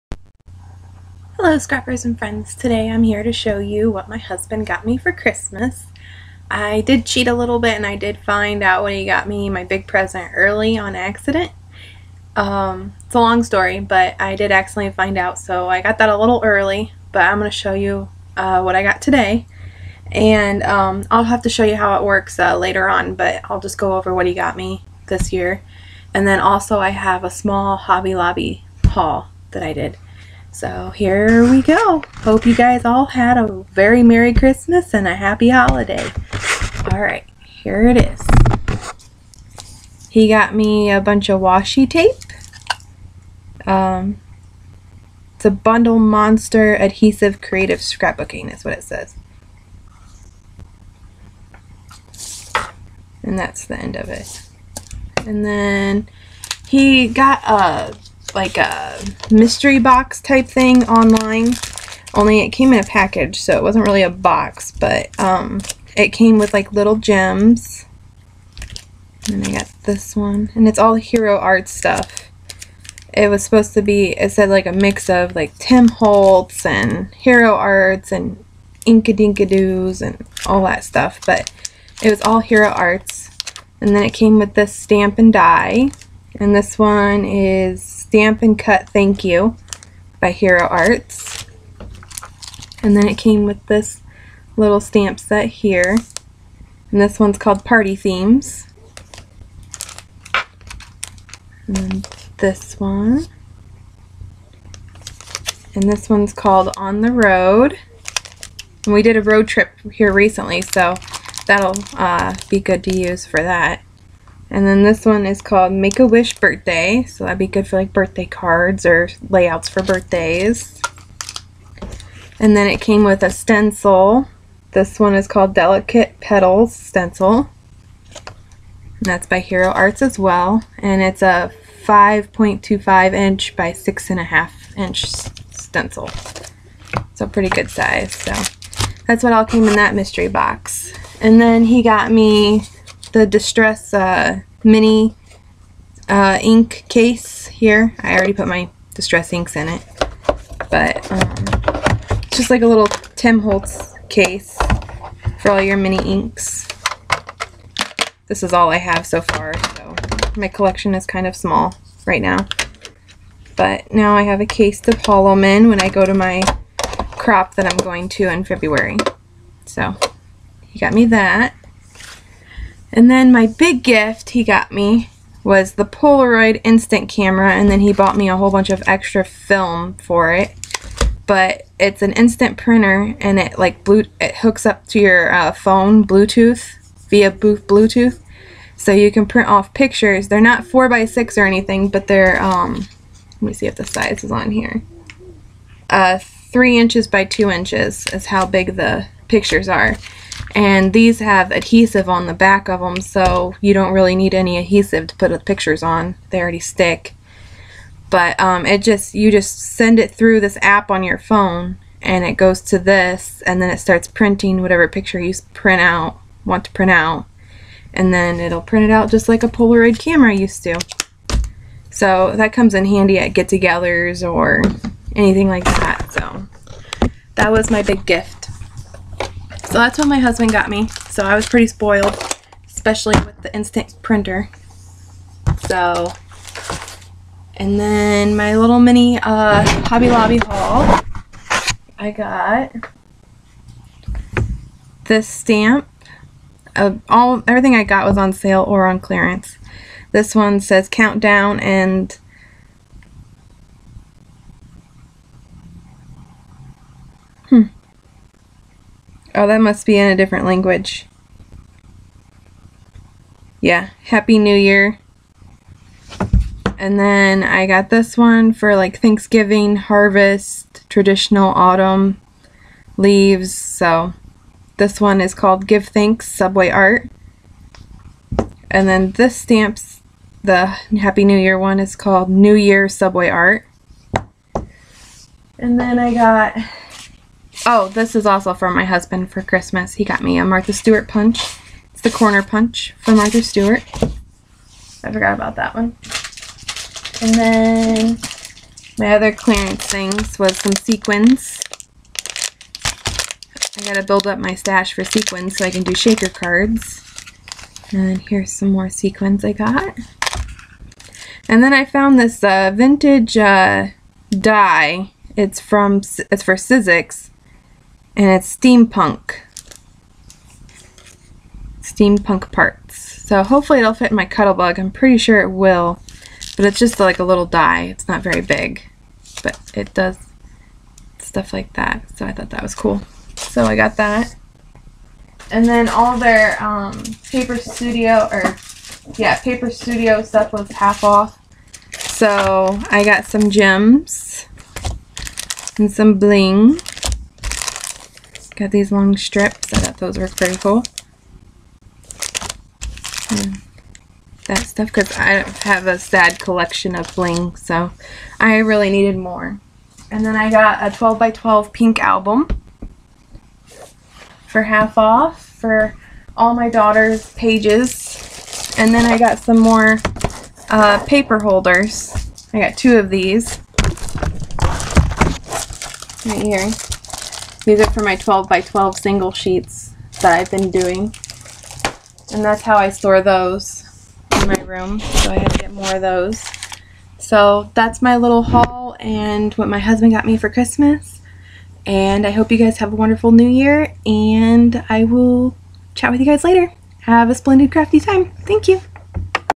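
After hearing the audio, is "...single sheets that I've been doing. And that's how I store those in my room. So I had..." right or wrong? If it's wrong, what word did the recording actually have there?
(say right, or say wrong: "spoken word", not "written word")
right.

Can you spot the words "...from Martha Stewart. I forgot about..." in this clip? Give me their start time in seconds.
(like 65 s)
292 s.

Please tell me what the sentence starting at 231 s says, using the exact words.
So I was pretty spoiled, especially with the instant printer.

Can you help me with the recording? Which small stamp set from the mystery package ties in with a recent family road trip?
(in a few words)
On the Road.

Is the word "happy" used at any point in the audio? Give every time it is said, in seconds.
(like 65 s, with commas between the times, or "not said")
35 s, 264 s, 280 s.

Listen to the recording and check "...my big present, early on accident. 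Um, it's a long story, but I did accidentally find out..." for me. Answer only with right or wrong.
right.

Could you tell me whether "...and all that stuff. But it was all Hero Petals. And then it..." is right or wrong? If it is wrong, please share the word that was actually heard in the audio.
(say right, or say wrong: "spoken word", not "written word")
wrong: "Arts", not "Petals".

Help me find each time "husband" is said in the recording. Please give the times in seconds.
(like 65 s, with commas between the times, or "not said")
4 s, 230 s, 288 s, 389 s.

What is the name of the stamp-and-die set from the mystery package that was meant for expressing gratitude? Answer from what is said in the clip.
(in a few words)
Stamp and Cut Thank You.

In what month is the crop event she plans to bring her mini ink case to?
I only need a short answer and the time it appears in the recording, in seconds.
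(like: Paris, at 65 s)
February, at 168 s.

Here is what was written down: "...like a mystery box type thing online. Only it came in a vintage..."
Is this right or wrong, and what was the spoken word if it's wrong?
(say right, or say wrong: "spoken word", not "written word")
wrong: "package", not "vintage".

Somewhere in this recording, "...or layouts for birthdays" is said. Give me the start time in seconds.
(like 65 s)
118 s.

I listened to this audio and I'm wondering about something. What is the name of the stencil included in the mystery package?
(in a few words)
Delicate Petals Stencil.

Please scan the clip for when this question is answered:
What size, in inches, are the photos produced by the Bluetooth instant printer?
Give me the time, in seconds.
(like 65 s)
196 s.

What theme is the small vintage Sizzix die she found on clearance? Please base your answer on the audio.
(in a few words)
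Steampunk parts.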